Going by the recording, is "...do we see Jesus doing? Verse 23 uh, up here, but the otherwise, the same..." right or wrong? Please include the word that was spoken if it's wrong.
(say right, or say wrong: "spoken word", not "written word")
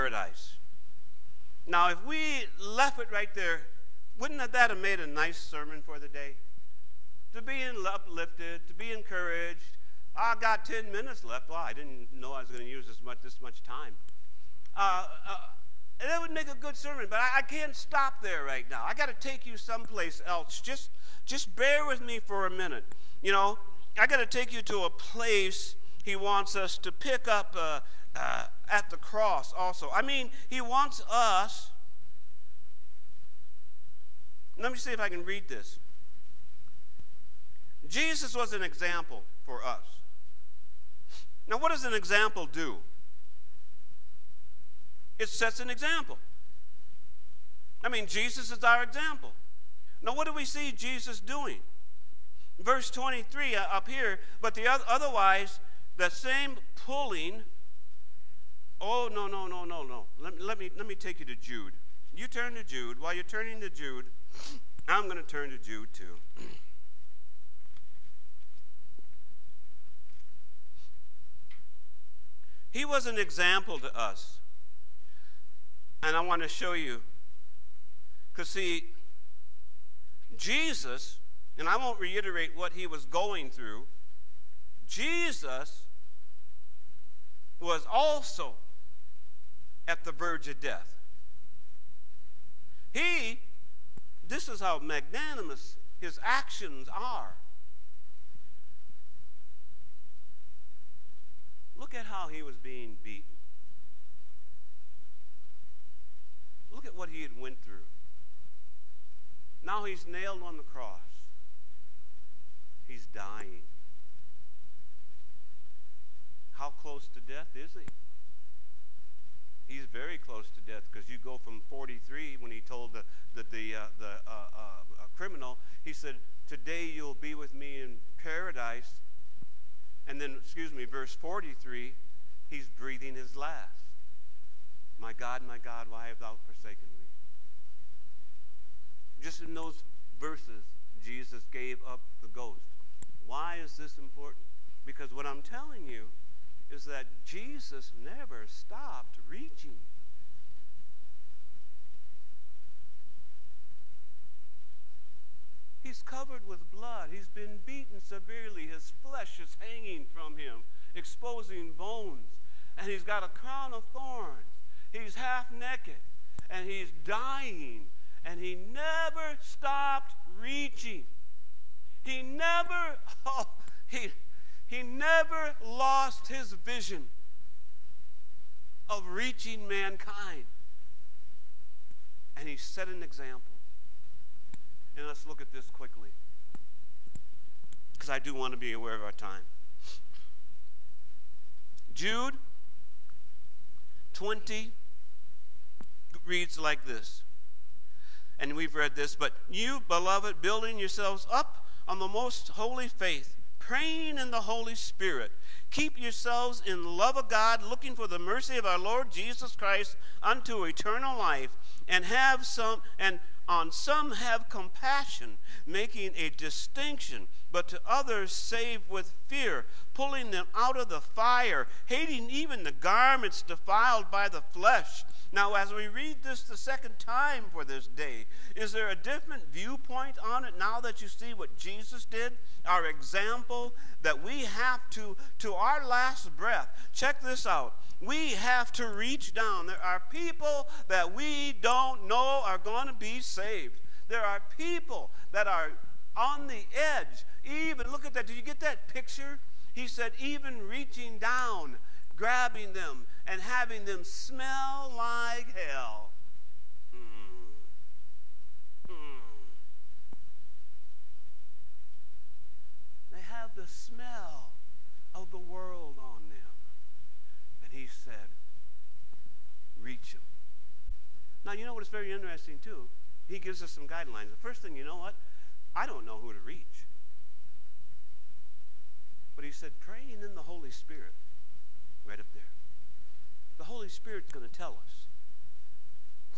right.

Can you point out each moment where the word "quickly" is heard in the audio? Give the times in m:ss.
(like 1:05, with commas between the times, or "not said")
3:05.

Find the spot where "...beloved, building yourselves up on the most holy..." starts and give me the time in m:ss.
3:19.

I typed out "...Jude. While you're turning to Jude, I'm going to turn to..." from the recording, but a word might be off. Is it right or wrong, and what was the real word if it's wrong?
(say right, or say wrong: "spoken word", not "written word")
right.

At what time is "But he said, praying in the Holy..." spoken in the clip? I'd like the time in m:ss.
4:39.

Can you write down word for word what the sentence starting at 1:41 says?
Look at how he was being beaten.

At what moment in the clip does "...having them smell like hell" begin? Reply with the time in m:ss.
4:13.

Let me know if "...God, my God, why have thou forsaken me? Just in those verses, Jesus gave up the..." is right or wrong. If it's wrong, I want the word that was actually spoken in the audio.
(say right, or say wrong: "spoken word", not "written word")
right.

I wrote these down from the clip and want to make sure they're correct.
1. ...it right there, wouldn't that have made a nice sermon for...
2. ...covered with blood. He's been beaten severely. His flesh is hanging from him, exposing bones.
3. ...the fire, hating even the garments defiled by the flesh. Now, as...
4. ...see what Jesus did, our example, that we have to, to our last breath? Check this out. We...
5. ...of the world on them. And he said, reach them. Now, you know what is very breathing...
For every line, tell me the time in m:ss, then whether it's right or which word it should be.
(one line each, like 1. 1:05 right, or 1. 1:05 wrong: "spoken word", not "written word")
1. 0:02 right
2. 2:36 right
3. 3:40 right
4. 3:51 right
5. 4:25 wrong: "interesting", not "breathing".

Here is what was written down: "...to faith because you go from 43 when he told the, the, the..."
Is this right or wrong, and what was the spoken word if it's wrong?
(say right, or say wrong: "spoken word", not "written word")
wrong: "death", not "faith".